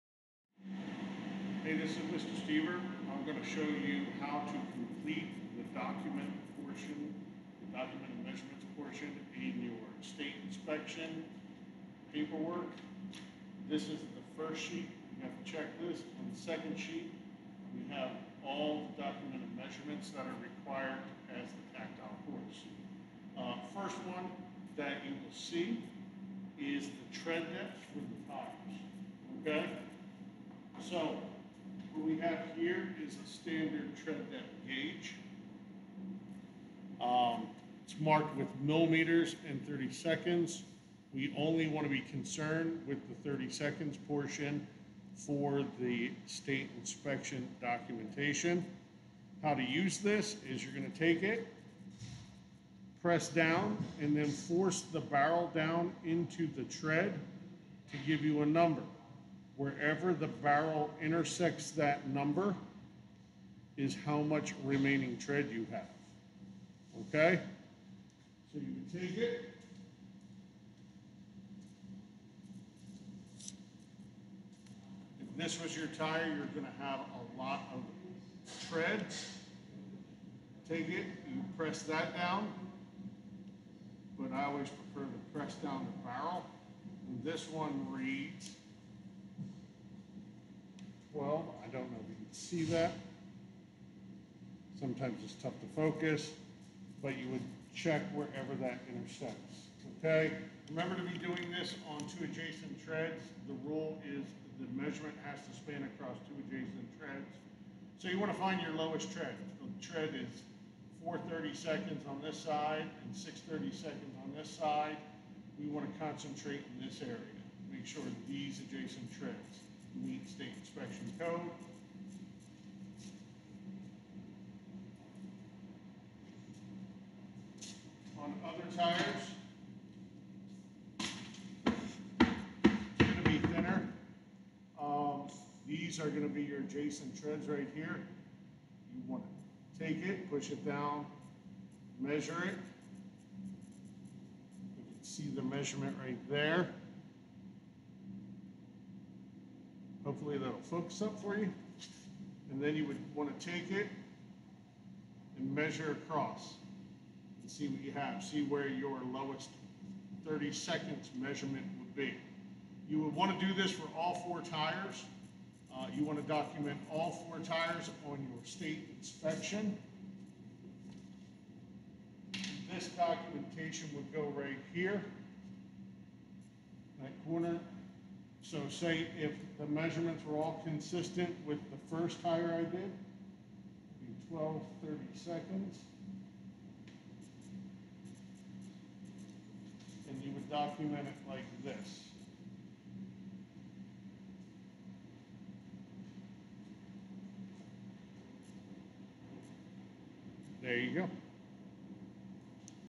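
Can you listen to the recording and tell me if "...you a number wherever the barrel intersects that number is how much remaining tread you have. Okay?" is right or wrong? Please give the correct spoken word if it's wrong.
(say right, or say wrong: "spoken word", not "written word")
right.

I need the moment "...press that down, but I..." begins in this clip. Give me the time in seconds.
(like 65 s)
81 s.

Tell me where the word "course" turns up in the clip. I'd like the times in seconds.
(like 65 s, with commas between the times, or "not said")
22 s.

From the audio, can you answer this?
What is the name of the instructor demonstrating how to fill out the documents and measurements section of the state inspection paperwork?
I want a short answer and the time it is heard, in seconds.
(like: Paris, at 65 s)
Mr. Steever, at 2 s.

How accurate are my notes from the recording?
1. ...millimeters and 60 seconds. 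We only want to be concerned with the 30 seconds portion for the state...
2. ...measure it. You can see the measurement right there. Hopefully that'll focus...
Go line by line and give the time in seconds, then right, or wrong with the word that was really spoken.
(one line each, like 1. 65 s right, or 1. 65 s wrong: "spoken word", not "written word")
1. 38 s wrong: "30", not "60"
2. 141 s right.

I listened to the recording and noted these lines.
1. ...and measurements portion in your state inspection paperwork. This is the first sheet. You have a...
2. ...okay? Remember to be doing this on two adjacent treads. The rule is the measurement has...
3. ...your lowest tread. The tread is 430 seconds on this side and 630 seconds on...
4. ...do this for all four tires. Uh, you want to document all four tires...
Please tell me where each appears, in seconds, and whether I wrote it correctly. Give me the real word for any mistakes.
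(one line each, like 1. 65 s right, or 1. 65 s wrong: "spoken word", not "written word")
1. 8 s right
2. 99 s right
3. 108 s right
4. 163 s right.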